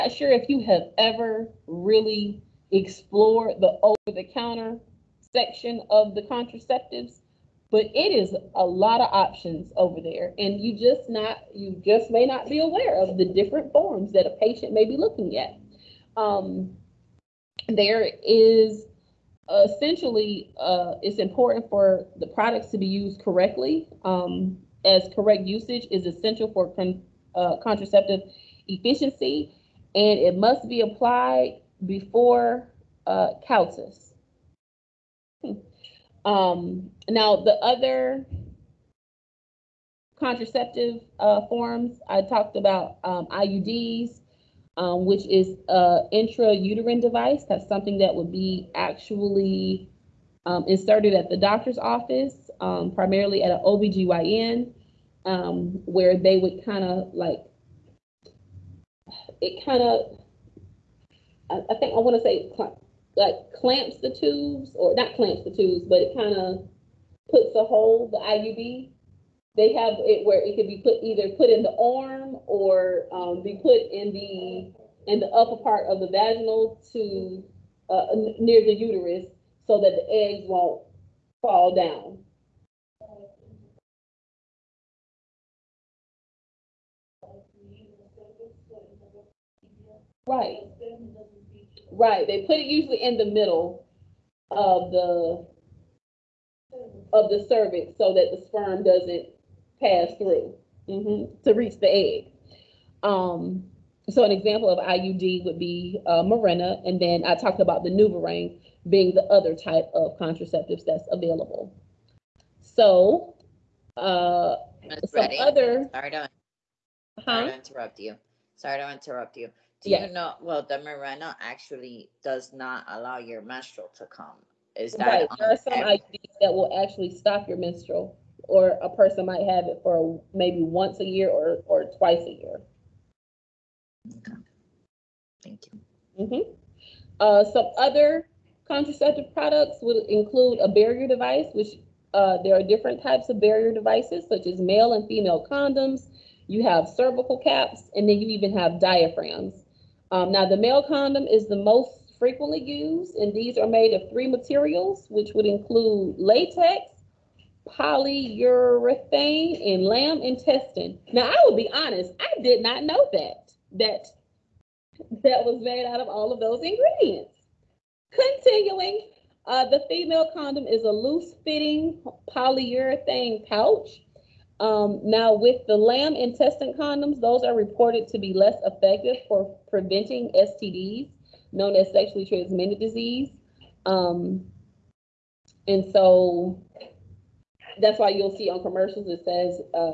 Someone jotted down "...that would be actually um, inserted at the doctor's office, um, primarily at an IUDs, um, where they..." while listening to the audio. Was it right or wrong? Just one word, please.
wrong.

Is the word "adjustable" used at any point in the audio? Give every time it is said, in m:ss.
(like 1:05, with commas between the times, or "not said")
not said.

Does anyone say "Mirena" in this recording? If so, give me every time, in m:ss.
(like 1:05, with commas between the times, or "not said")
1:46, 2:00.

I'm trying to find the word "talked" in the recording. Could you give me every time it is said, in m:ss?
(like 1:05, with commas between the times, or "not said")
0:42, 1:47.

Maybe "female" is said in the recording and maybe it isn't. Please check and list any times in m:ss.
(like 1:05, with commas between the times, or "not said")
2:25, 2:49.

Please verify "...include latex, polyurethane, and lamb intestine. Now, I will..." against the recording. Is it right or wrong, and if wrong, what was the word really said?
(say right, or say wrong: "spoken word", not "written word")
right.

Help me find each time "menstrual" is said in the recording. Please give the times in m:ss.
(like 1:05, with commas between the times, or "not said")
2:03, 2:07.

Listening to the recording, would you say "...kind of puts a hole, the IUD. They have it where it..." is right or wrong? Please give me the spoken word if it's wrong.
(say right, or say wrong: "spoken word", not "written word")
right.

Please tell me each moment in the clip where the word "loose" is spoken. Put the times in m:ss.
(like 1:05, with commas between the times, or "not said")
2:50.